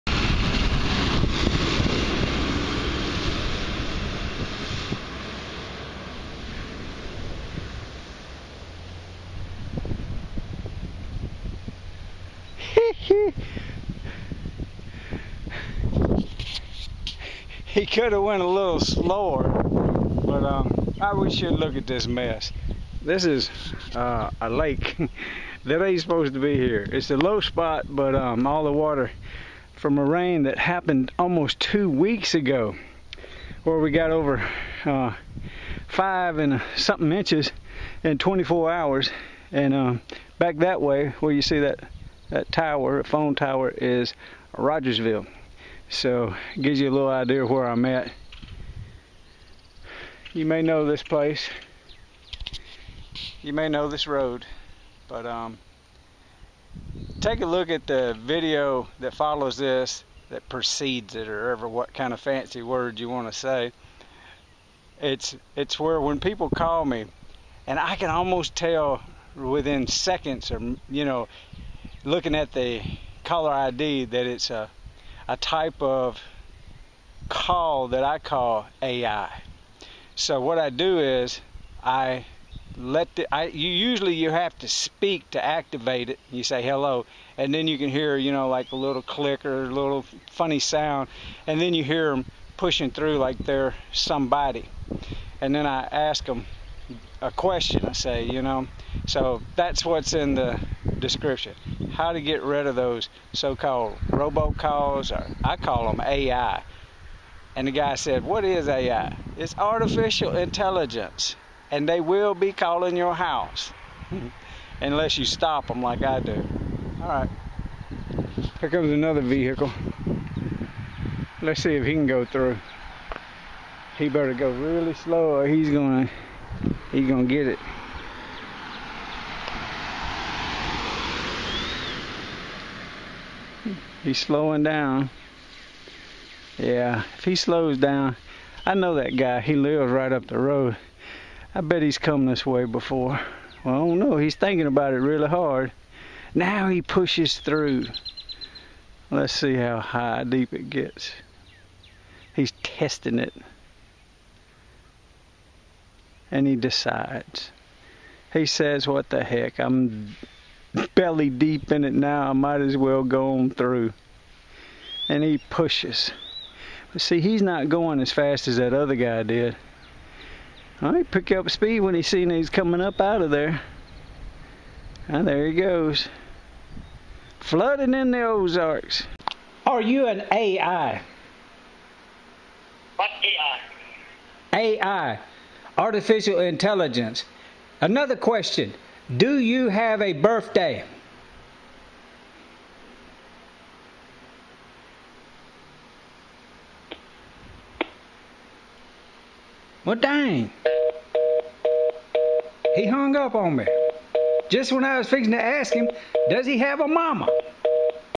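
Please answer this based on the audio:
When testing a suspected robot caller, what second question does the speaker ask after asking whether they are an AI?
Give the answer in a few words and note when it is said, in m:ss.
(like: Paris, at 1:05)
Do you have a birthday?, at 3:09.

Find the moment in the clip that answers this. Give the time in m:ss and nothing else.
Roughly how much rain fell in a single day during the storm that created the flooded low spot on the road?
0:34.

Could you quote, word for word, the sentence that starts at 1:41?
How to get rid of those so-called robocalls, or I call them AI.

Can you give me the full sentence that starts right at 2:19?
He lives right up the road.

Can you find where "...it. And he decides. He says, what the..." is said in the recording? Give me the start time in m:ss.
2:33.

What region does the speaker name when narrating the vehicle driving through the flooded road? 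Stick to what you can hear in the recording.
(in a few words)
the Ozarks.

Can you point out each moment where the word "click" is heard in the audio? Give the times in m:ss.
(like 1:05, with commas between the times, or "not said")
1:29.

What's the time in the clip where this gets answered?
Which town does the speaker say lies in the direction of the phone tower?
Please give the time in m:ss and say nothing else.
0:44.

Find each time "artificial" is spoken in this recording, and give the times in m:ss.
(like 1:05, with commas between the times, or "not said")
1:49, 3:05.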